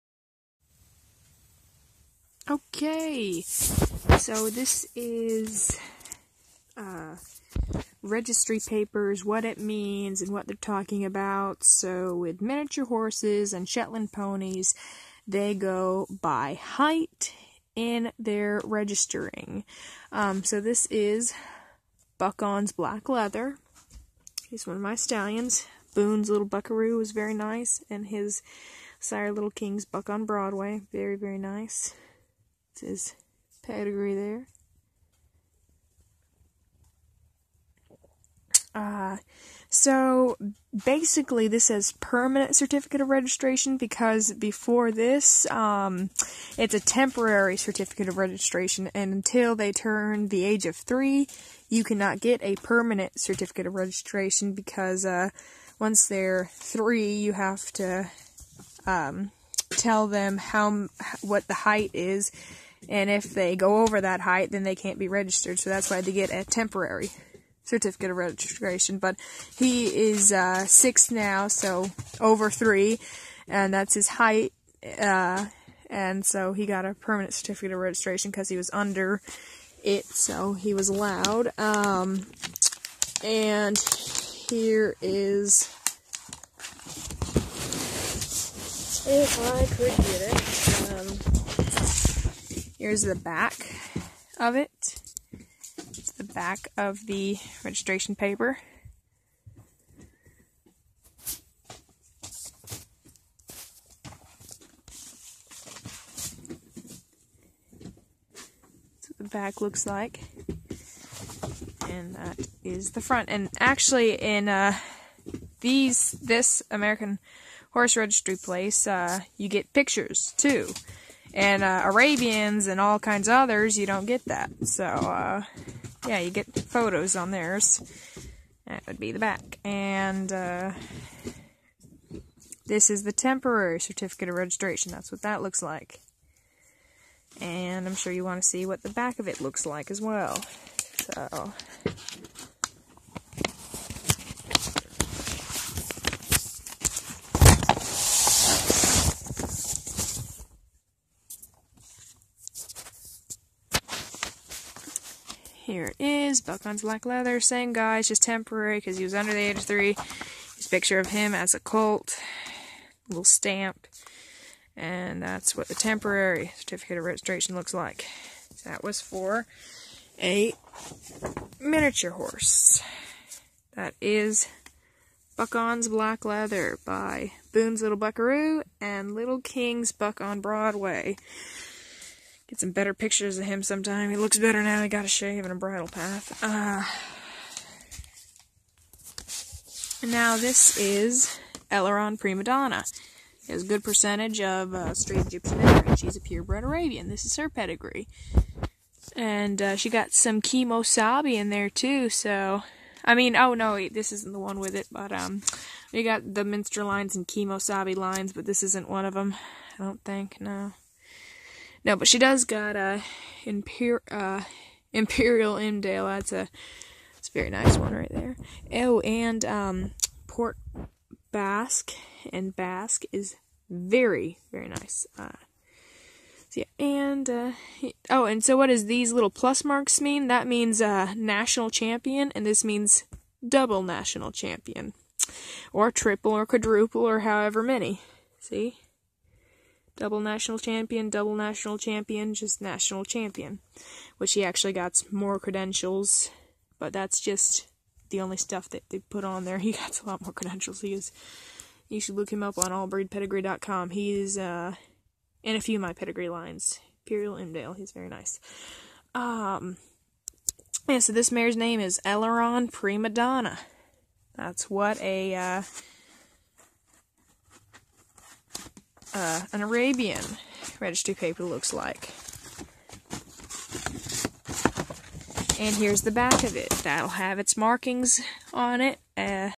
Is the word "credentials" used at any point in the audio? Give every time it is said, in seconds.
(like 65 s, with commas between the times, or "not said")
245 s, 250 s.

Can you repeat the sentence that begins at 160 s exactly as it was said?
His picture of him as a colt, little stamp, and that's what the temporary certificate of registration looks like.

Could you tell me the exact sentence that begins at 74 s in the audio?
Uh, and so he got a permanent certificate of registration because he was under it, so he was allowed.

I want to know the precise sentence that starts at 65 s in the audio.
So that's why they get a temporary certificate of registration.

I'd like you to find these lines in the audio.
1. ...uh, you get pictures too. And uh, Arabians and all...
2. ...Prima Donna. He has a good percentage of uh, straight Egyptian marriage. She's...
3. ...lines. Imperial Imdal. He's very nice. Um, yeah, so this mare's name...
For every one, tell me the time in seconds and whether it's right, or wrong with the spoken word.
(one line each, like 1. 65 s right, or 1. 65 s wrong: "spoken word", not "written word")
1. 118 s right
2. 192 s right
3. 256 s right.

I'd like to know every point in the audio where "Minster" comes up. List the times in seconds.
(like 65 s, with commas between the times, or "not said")
206 s.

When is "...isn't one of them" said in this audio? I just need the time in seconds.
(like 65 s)
208 s.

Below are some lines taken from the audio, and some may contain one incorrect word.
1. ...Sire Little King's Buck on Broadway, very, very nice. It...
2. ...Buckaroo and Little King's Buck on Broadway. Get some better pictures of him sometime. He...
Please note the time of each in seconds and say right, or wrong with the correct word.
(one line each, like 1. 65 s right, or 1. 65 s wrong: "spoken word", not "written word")
1. 28 s right
2. 177 s right.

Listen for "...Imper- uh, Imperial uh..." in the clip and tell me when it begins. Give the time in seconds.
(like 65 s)
213 s.